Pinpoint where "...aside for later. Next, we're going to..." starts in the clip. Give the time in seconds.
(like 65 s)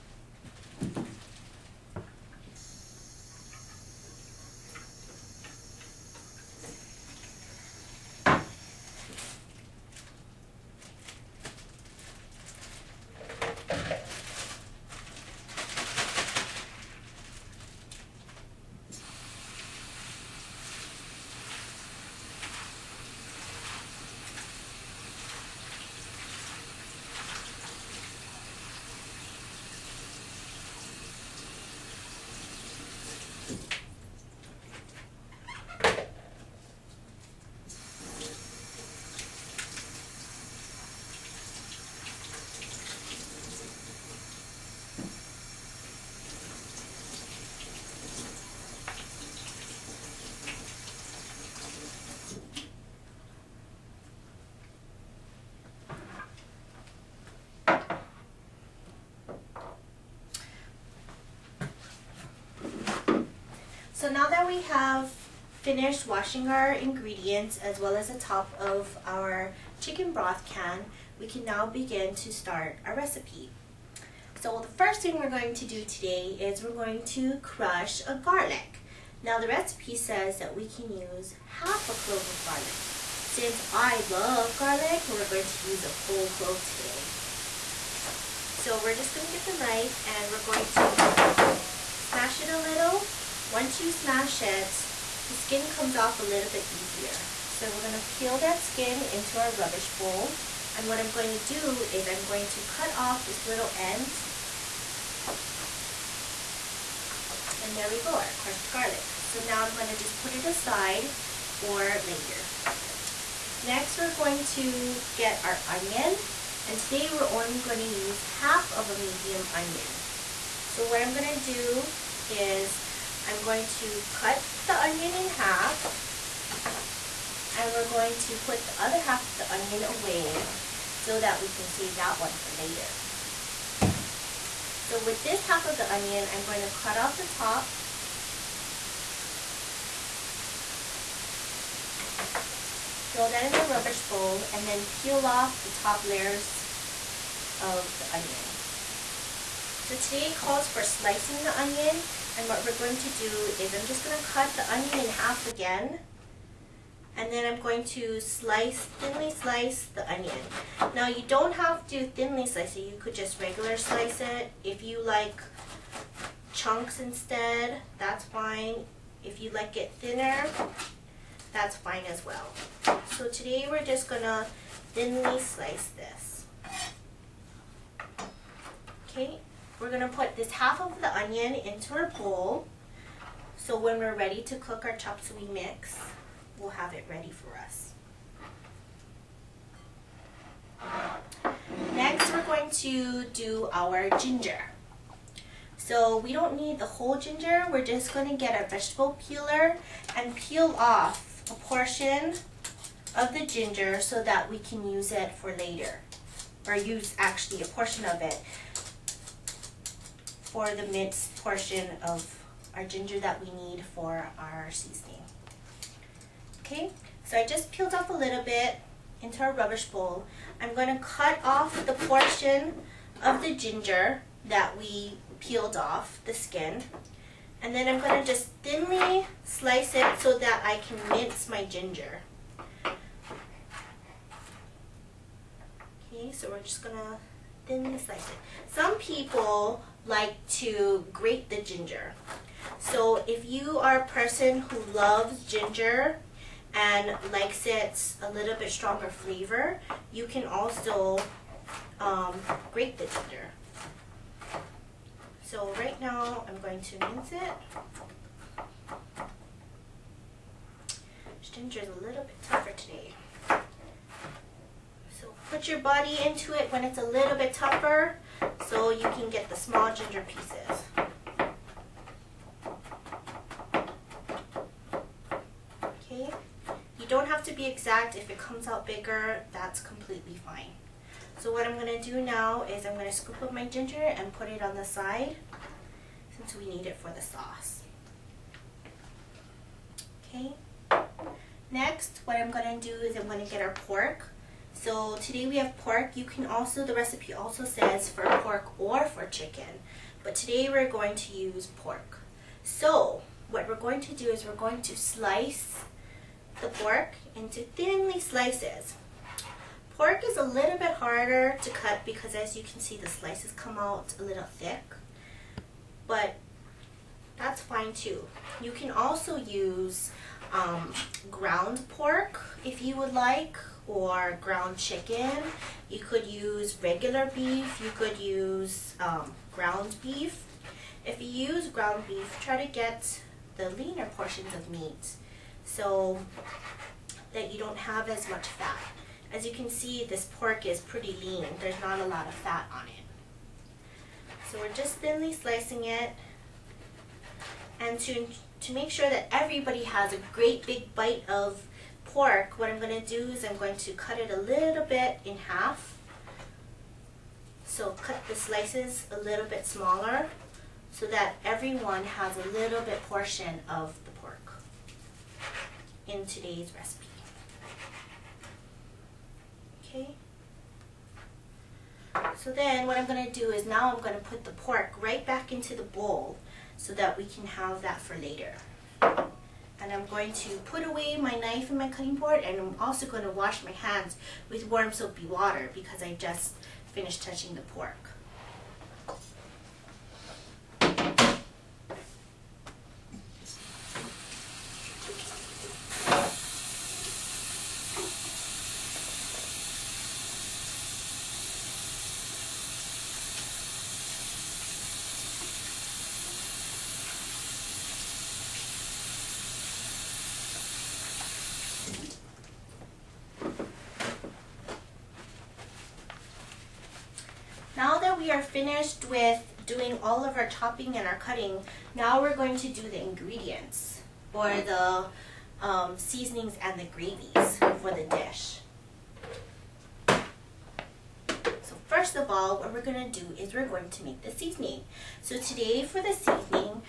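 110 s.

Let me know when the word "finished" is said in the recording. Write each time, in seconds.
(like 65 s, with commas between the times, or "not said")
65 s, 386 s, 418 s.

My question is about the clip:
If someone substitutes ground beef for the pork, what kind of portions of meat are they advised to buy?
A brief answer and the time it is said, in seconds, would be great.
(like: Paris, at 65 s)
leaner portions, at 333 s.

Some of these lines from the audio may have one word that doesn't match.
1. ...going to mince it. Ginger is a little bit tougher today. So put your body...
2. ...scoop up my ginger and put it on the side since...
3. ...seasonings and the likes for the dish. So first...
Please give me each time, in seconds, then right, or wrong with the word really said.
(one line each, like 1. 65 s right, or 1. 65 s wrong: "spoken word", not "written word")
1. 256 s right
2. 283 s right
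3. 425 s wrong: "gravies", not "likes".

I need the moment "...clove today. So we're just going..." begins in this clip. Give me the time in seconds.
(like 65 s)
86 s.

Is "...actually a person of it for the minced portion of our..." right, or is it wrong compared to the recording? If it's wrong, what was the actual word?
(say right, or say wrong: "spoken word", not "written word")
wrong: "portion", not "person".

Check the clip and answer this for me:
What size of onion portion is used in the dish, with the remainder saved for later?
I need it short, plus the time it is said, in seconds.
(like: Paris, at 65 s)
half of a medium onion, at 118 s.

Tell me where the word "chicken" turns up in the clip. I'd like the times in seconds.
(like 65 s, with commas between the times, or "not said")
69 s, 299 s, 324 s.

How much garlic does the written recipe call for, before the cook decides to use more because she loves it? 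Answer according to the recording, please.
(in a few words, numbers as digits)
half a clove.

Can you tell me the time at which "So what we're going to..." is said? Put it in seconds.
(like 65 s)
302 s.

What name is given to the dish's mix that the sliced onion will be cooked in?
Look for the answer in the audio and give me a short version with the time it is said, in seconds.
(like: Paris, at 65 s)
chop suey, at 184 s.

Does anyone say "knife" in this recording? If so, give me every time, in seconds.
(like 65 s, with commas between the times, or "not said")
89 s, 381 s.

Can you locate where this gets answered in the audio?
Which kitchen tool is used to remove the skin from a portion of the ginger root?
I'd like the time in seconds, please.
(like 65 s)
198 s.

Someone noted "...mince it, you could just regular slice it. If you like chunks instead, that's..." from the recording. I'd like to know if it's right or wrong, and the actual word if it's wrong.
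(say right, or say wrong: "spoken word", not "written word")
wrong: "slice", not "mince".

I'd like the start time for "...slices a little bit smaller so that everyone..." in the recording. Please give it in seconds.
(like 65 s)
358 s.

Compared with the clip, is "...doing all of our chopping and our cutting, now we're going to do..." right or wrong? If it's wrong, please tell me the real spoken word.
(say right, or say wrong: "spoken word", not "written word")
right.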